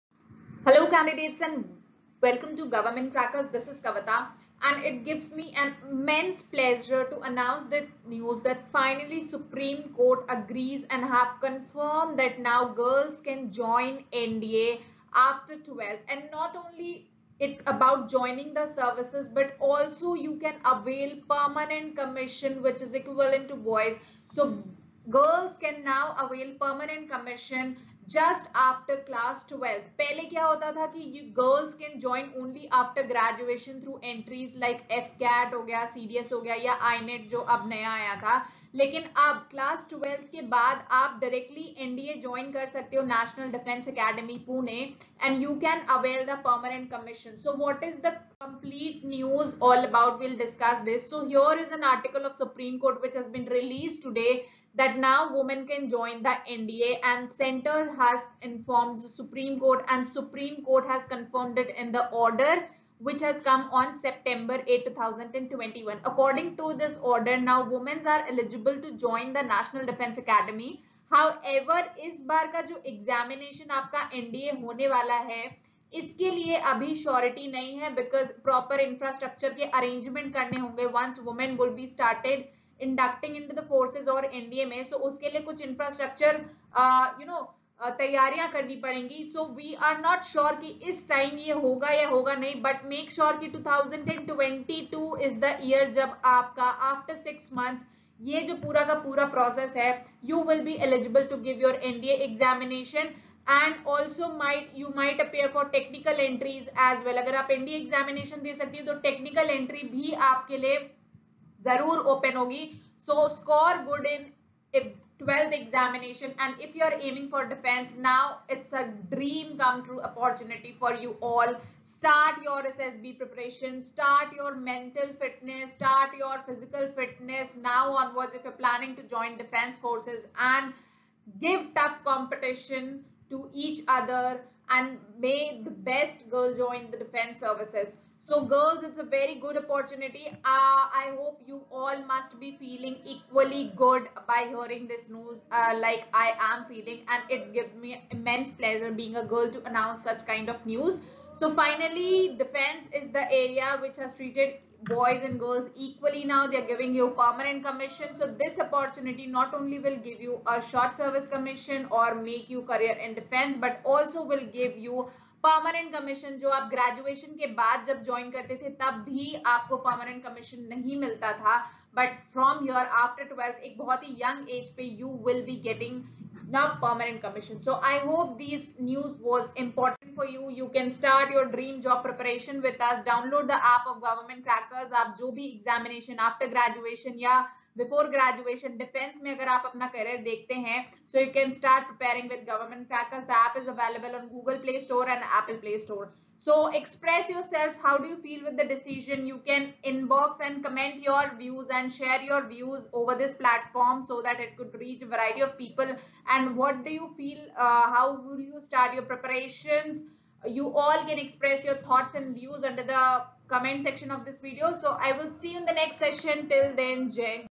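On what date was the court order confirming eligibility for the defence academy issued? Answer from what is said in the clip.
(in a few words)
September 8, 2021.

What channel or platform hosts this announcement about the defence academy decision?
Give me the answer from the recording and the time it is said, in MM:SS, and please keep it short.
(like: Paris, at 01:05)
Government Crackers, at 00:02.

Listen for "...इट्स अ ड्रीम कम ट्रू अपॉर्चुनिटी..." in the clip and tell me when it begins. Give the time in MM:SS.
01:58.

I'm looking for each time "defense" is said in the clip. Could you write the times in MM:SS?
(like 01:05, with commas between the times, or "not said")
00:43, 01:09, 02:09, 02:17, 02:32, 02:43, 03:08.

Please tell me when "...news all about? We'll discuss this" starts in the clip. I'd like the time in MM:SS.
00:49.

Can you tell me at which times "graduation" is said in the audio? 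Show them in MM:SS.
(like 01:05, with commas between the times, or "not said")
00:33, 03:08.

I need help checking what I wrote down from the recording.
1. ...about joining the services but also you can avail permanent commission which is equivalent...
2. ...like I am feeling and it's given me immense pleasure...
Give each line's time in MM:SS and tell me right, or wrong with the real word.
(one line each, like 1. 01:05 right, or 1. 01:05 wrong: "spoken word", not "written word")
1. 00:17 right
2. 02:25 right.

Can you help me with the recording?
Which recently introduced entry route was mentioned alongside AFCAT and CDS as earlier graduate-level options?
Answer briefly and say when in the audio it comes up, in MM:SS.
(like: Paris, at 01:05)
INET, at 00:36.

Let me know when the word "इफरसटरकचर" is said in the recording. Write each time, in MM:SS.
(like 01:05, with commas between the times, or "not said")
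01:19, 01:25.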